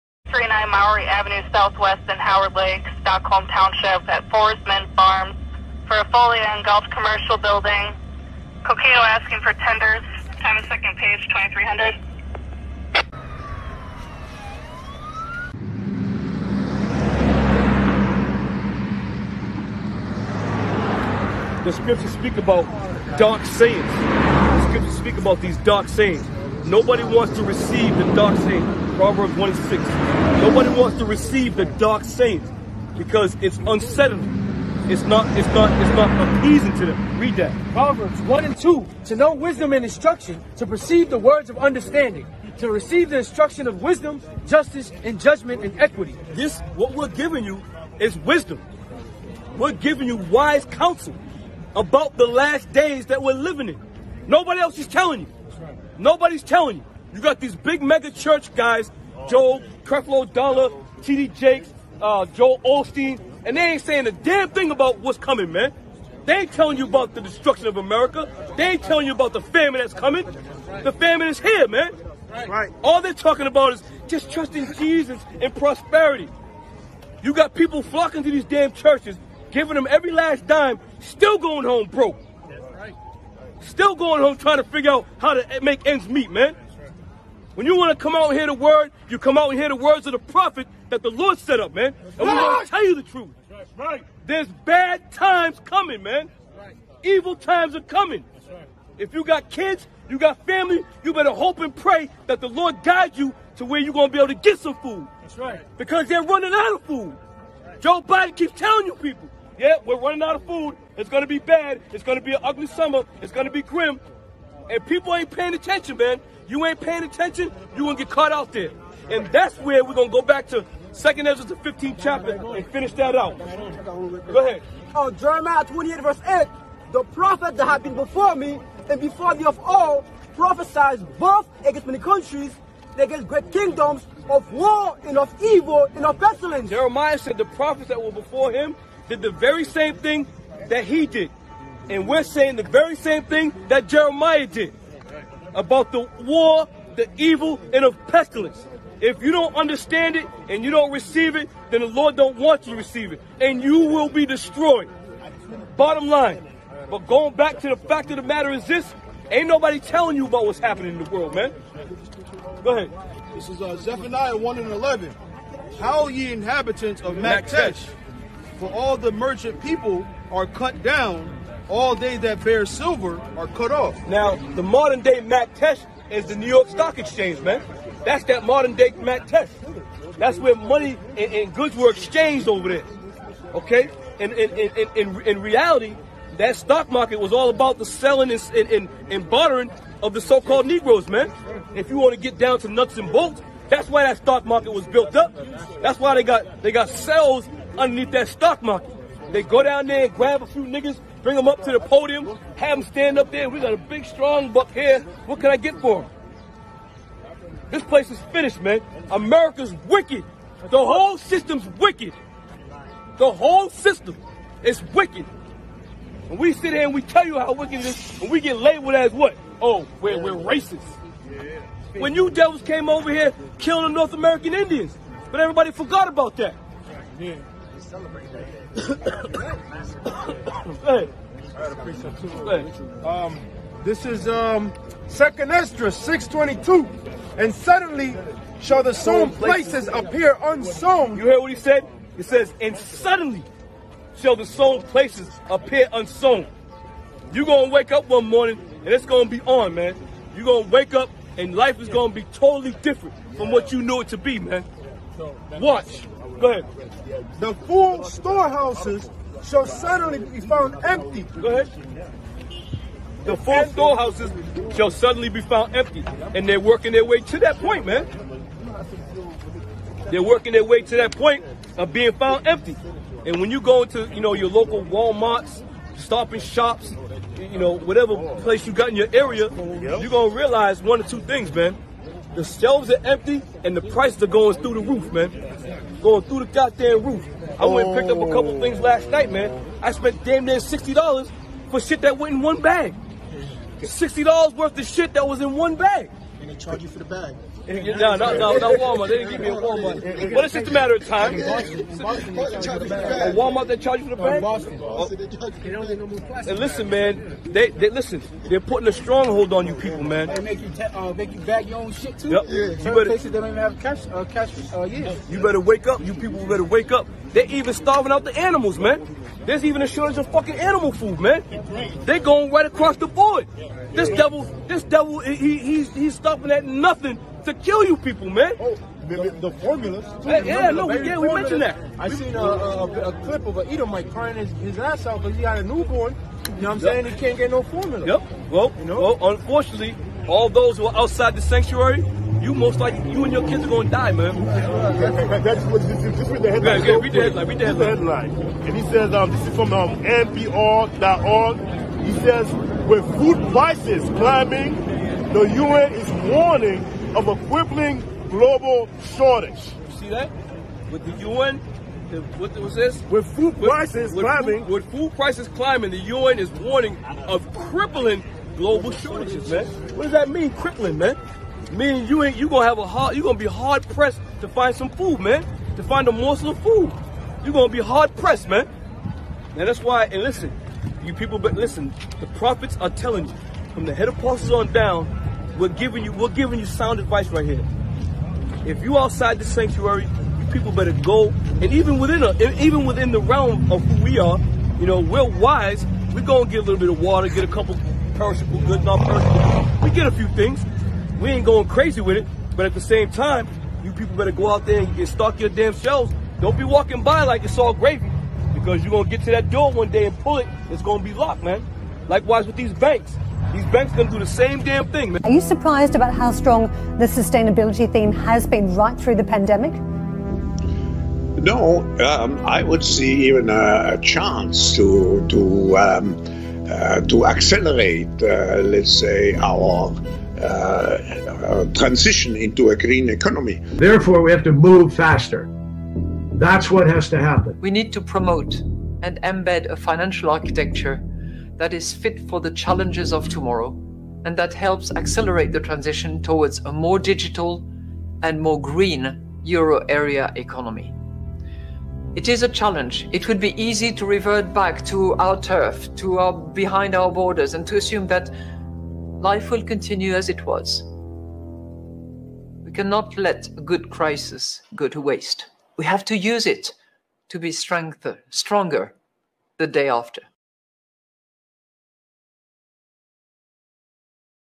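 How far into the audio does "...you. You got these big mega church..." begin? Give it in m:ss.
0:56.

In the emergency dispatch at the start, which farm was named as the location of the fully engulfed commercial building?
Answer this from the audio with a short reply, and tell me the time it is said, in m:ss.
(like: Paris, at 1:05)
Forestman Farms, at 0:04.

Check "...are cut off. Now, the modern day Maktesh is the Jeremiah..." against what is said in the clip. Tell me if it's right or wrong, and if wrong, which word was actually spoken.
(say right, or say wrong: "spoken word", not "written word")
wrong: "New", not "Jeremiah".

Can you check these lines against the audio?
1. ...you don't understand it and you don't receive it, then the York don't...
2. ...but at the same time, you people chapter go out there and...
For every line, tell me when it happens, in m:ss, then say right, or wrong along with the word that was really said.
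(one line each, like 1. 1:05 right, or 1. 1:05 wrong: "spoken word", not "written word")
1. 2:29 wrong: "Lord", not "York"
2. 6:42 wrong: "better", not "chapter".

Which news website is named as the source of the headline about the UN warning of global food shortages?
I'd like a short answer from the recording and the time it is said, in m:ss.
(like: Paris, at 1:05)
NPR.org, at 5:50.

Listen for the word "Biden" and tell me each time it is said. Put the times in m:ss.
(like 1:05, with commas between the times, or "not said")
1:48.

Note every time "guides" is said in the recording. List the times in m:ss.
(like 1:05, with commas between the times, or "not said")
1:42.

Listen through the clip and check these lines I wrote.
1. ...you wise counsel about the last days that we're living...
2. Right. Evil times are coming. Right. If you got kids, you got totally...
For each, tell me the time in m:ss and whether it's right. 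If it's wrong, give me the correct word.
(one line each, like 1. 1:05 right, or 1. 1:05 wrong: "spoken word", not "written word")
1. 0:50 right
2. 1:36 wrong: "family", not "totally".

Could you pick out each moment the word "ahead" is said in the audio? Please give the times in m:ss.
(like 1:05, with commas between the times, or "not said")
2:04, 2:42, 4:16, 4:21.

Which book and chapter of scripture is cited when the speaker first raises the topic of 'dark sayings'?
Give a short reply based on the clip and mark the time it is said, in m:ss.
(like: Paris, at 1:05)
Proverbs 1, at 0:28.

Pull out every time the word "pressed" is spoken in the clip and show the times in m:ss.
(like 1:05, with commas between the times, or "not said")
6:13, 6:18.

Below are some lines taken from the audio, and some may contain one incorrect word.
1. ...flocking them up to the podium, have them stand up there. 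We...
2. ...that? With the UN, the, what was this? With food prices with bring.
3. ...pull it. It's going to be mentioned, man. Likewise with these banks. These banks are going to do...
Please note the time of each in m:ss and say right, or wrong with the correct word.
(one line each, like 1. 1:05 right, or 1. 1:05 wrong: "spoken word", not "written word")
1. 3:21 wrong: "bring", not "flocking"
2. 6:00 wrong: "climbing", not "bring"
3. 6:50 wrong: "locked", not "mentioned".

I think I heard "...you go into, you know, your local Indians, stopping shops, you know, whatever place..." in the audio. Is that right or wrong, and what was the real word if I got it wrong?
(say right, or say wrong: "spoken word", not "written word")
wrong: "Walmarts", not "Indians".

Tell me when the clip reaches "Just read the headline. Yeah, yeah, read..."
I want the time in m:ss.
5:46.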